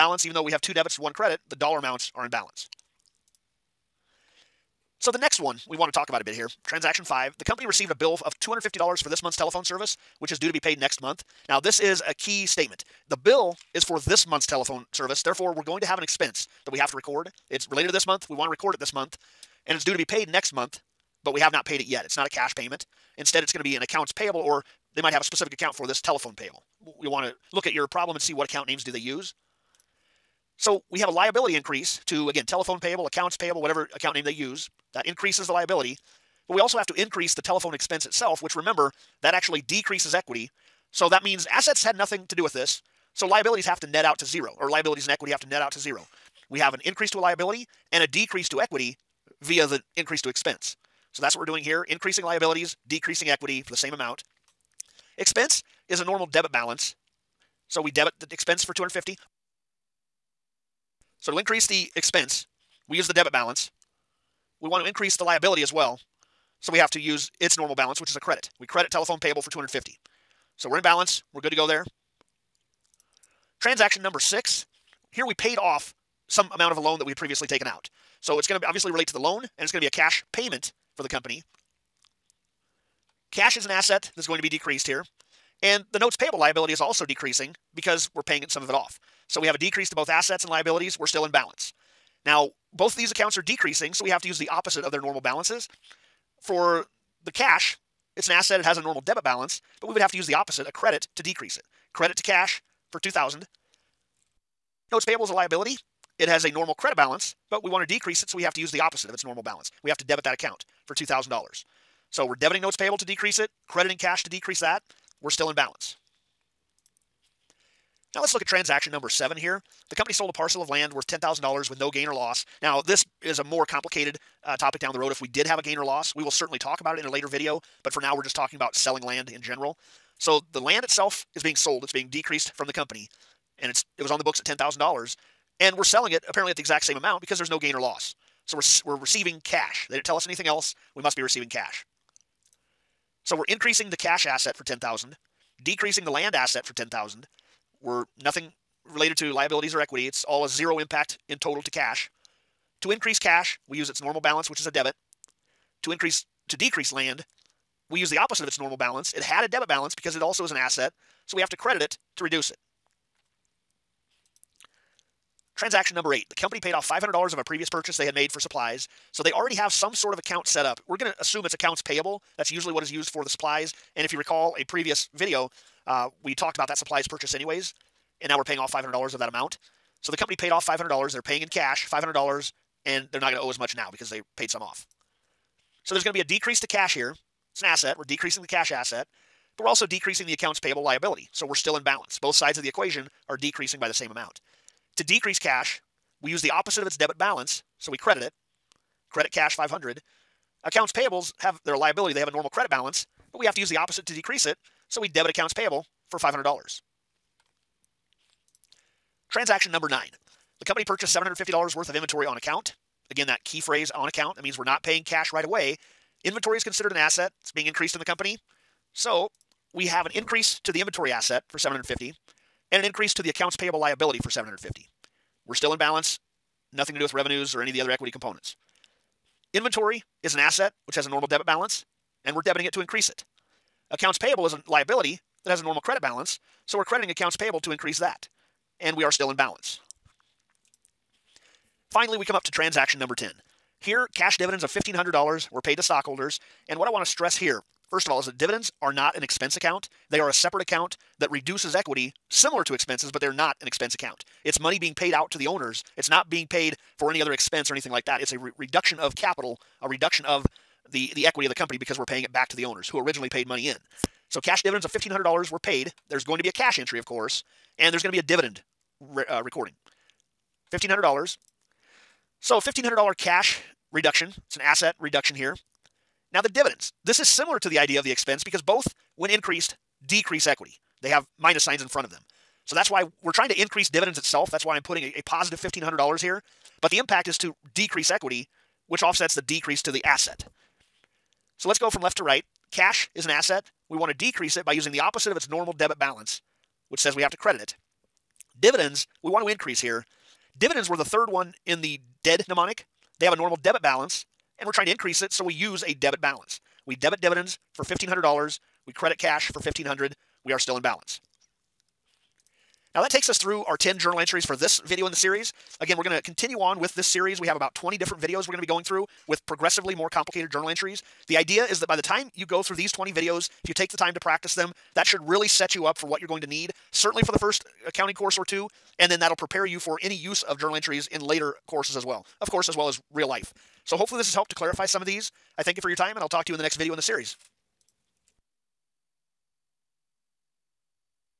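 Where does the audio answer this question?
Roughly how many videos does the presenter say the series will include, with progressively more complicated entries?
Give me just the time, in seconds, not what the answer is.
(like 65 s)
317 s.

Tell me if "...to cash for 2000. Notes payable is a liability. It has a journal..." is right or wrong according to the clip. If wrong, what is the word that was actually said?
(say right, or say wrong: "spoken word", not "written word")
wrong: "normal", not "journal".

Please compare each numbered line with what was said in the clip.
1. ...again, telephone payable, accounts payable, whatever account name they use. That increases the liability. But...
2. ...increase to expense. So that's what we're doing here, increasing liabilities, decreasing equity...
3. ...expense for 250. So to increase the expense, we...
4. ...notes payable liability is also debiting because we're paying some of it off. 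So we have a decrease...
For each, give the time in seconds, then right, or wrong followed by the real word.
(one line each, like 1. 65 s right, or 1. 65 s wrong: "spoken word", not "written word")
1. 32 s right
2. 49 s right
3. 58 s right
4. 85 s wrong: "decreasing", not "debiting".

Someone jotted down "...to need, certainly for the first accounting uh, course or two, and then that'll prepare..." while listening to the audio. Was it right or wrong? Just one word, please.
right.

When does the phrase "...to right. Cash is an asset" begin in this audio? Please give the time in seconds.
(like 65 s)
292 s.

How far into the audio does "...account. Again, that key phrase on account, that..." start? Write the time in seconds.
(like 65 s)
212 s.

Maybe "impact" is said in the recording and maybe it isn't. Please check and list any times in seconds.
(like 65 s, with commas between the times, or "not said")
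150 s, 286 s.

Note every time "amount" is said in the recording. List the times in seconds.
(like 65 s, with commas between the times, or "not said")
1 s, 53 s, 76 s, 136 s, 179 s, 194 s.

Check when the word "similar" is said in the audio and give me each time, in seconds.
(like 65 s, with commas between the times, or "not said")
252 s, 277 s.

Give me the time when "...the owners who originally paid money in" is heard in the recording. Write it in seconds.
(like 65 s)
262 s.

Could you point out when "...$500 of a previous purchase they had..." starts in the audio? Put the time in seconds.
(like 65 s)
166 s.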